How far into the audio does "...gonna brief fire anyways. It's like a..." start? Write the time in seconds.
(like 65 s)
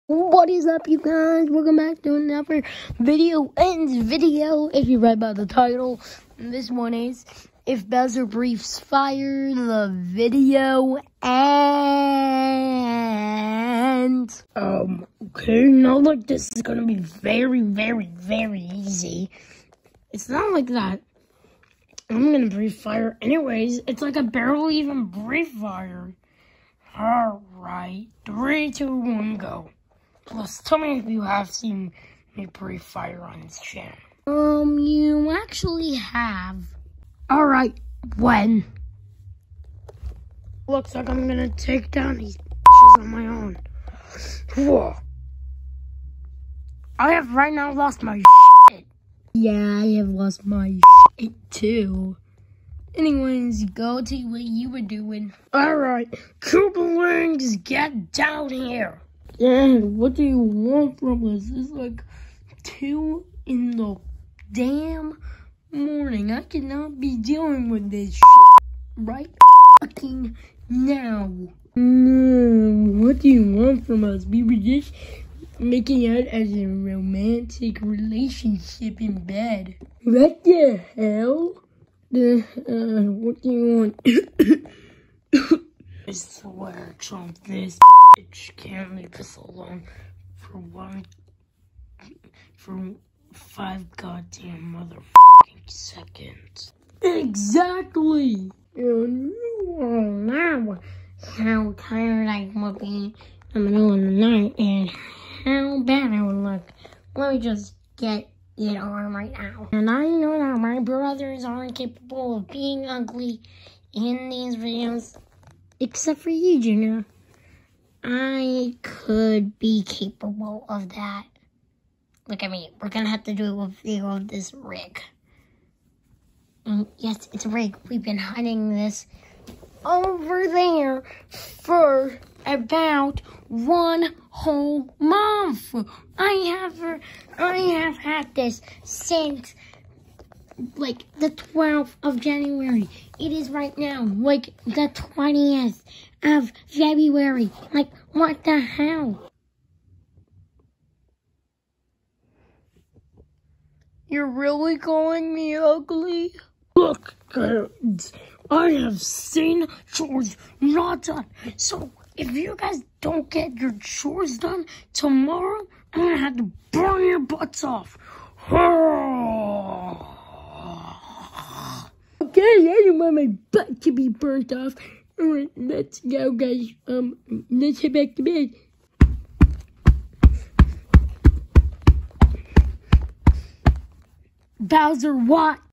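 22 s.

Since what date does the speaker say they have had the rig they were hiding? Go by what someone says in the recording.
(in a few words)
12th of January.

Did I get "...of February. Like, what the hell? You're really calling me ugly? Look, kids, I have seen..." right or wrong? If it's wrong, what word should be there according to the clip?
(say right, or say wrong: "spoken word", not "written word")
right.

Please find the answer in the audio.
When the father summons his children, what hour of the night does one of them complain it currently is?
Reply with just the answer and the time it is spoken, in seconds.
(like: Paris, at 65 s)
2 in the morning, at 62 s.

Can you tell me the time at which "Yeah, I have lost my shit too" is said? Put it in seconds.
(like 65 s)
49 s.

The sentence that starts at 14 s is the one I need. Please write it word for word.
Um, okay, not like this is gonna be very, very, very easy.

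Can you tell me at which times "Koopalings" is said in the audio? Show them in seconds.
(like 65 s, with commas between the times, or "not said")
56 s.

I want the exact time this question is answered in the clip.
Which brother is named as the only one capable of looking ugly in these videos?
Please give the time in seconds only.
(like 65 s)
116 s.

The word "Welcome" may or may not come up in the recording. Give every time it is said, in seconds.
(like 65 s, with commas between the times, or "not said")
1 s.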